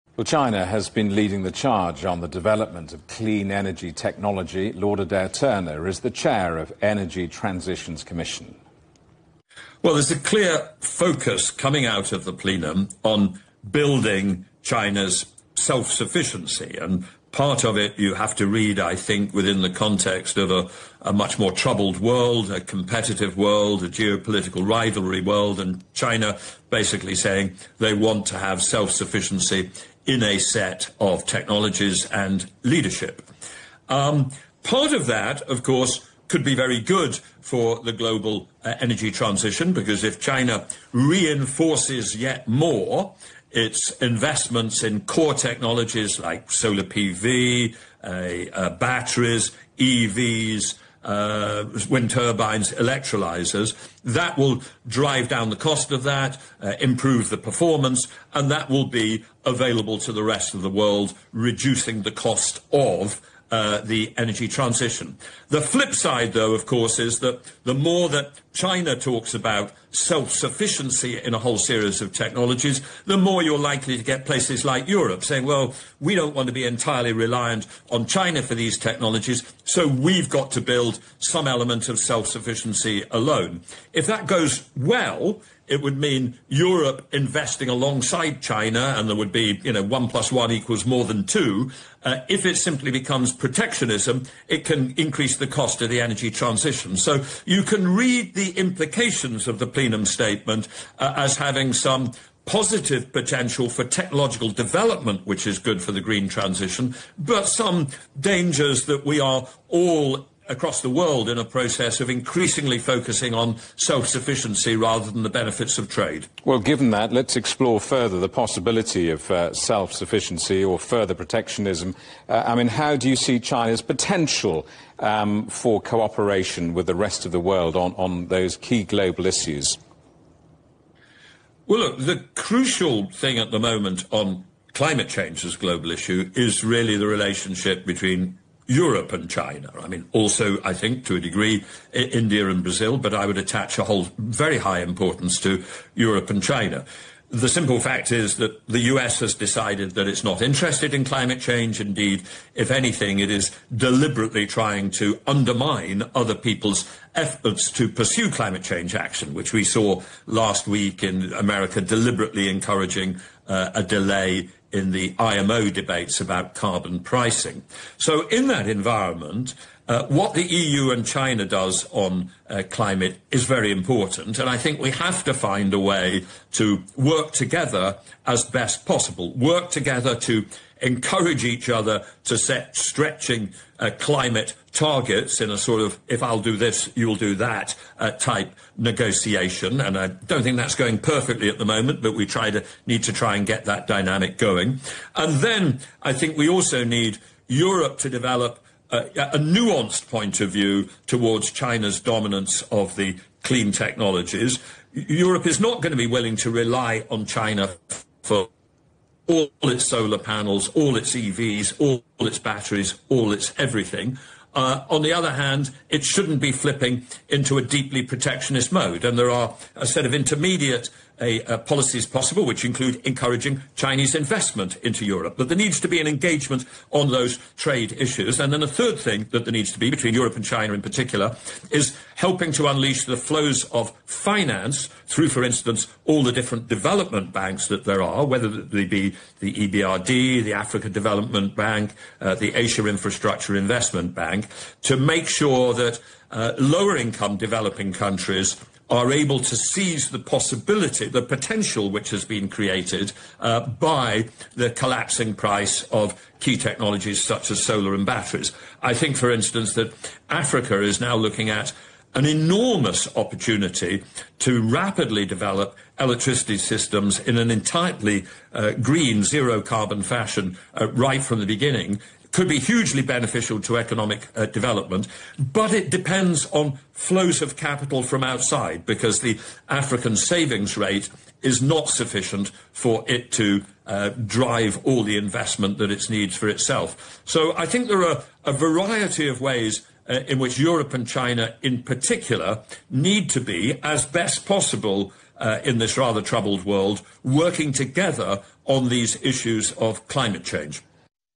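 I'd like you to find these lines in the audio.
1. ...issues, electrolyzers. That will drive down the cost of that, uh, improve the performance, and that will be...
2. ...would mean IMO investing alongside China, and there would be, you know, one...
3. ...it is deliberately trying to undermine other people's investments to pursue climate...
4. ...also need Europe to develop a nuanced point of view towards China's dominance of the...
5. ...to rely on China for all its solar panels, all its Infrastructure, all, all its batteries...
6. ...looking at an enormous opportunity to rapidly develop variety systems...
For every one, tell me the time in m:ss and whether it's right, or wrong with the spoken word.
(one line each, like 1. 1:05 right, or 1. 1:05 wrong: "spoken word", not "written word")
1. 0:52 wrong: "turbines", not "issues"
2. 1:25 wrong: "Europe", not "IMO"
3. 2:33 wrong: "efforts", not "investments"
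4. 3:16 right
5. 3:26 wrong: "EVs", not "Infrastructure"
6. 4:21 wrong: "electricity", not "variety".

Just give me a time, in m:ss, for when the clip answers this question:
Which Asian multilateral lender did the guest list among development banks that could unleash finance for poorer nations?
4:02.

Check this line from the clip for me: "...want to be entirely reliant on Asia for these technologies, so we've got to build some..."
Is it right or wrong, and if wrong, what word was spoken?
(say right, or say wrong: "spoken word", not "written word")
wrong: "China", not "Asia".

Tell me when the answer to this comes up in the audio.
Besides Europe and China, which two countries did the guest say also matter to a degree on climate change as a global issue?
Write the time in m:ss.
2:21.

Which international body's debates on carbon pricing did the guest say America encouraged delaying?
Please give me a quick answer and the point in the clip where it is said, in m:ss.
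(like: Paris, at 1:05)
IMO, at 2:45.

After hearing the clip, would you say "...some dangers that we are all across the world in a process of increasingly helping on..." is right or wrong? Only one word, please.
wrong.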